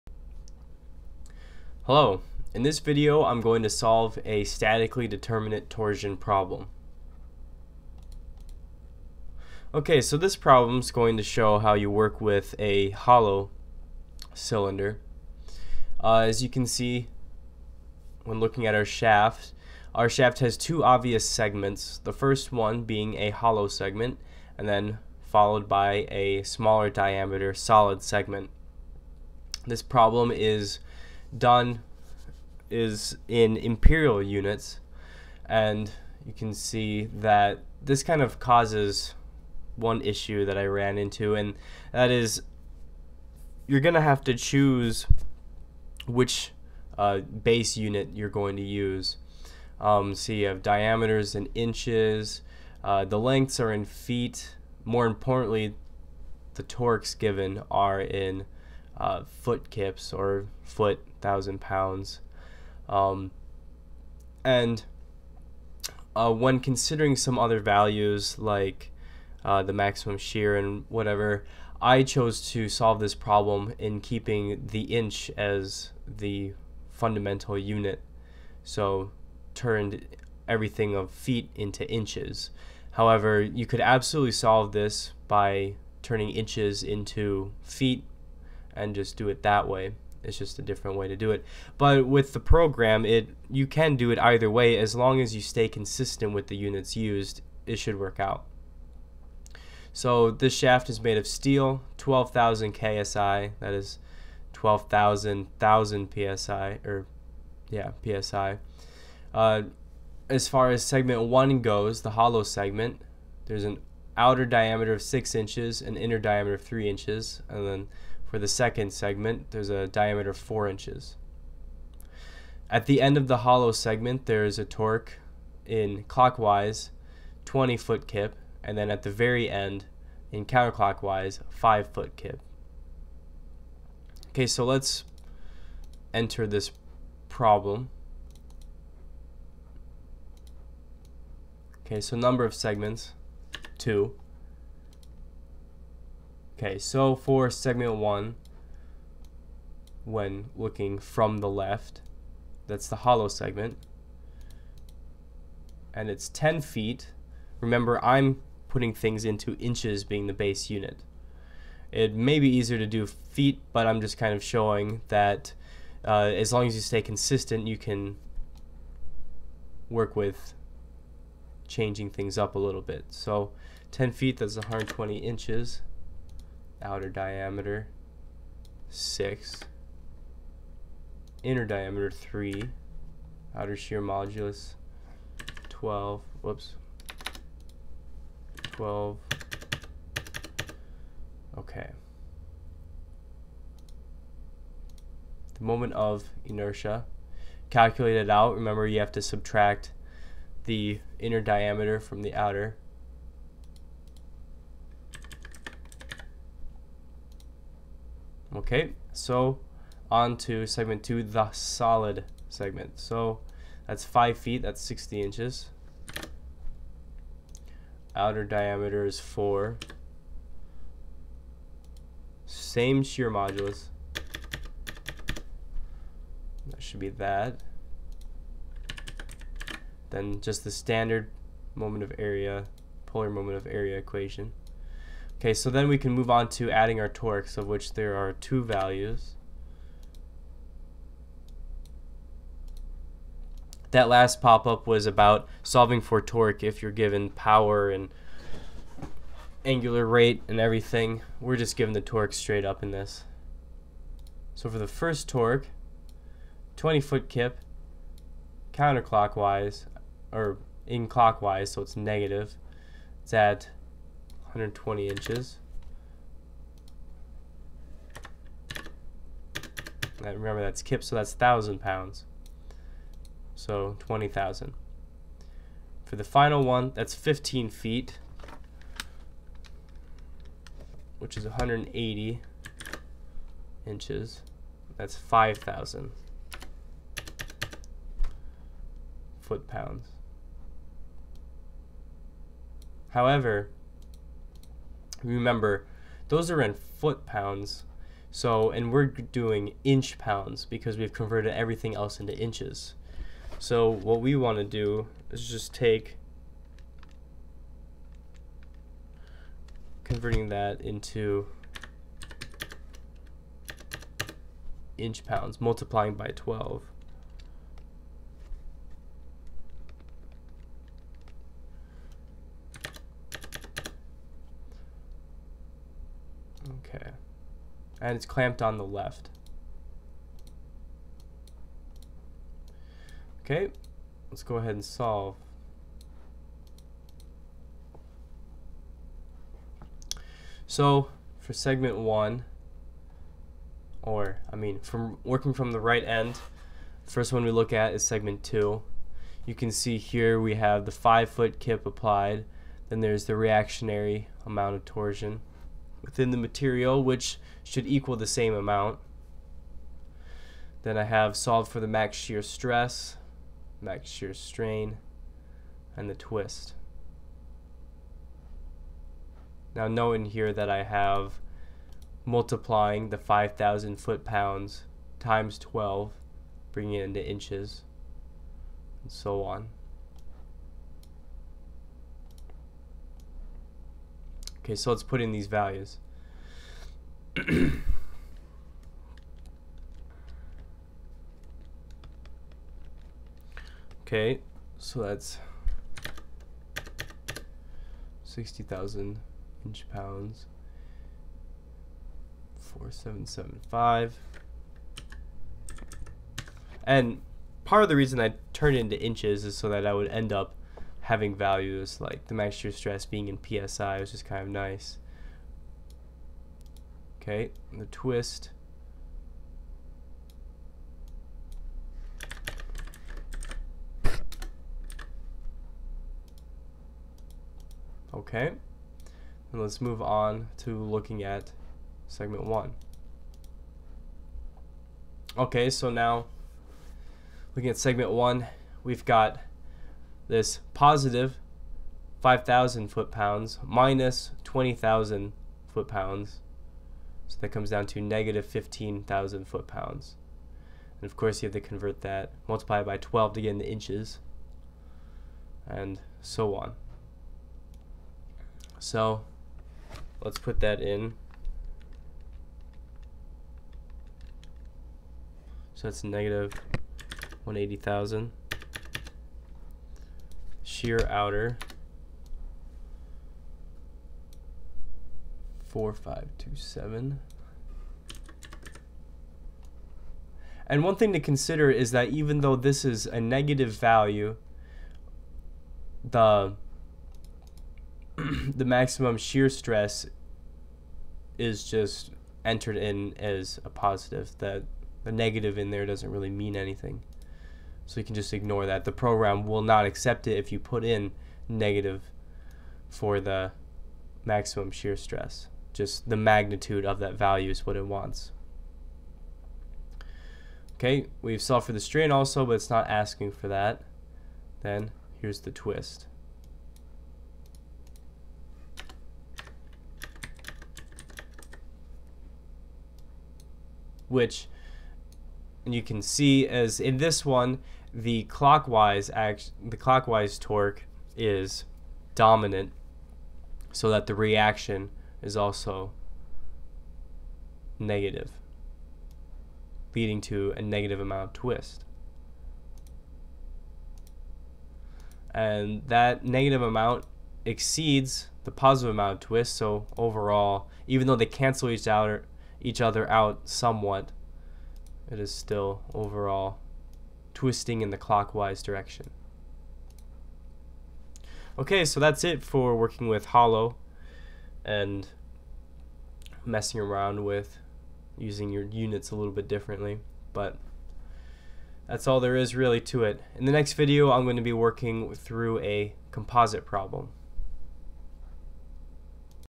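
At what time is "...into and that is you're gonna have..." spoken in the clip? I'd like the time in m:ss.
0:40.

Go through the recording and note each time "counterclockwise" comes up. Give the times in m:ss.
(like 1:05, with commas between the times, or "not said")
2:10, 4:18.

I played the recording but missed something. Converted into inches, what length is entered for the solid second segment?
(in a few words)
60 inches.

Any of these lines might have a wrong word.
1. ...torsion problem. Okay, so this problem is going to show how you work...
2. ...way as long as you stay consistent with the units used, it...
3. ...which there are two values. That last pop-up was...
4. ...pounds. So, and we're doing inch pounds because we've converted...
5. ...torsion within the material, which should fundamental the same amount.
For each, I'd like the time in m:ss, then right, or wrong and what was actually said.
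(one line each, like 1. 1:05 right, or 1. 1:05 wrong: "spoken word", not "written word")
1. 0:05 right
2. 1:34 right
3. 3:57 right
4. 4:57 right
5. 5:54 wrong: "equal", not "fundamental".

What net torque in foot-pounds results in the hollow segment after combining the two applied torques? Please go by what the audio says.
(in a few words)
-15,000 foot-pounds.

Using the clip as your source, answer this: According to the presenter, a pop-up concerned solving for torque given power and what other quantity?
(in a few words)
angular rate.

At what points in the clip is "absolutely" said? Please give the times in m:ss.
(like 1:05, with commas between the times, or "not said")
1:23.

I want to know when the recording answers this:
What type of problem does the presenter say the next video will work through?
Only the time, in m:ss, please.
9:36.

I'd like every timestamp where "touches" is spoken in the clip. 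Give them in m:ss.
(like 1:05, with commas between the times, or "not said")
not said.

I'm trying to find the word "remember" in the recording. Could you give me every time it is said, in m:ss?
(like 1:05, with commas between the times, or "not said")
2:37, 3:18, 4:30, 4:55.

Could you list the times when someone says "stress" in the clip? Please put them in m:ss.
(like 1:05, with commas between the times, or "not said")
6:02, 6:52, 8:09, 8:24.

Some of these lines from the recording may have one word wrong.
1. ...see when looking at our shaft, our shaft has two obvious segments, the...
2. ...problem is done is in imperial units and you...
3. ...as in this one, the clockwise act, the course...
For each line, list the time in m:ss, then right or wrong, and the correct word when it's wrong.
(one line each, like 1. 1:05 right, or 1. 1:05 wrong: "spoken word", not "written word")
1. 0:16 right
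2. 0:29 right
3. 8:46 wrong: "clockwise", not "course".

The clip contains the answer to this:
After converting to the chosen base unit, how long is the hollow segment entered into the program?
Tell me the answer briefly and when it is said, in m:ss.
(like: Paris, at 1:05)
120 inches, at 2:54.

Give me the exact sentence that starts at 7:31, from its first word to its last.
And of course you have to convert that, multiply by 12 to get the inches, and so on.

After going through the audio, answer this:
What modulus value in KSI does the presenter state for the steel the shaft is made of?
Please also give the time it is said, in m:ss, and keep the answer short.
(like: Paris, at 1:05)
12,000 KSI, at 1:41.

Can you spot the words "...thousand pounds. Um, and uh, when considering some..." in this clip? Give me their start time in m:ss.
1:01.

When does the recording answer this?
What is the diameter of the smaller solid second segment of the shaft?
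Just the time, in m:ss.
1:59.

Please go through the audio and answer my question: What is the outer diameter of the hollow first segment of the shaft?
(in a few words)
6 inches.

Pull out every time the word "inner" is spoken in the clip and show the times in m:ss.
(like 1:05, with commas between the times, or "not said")
1:55, 3:01, 3:21.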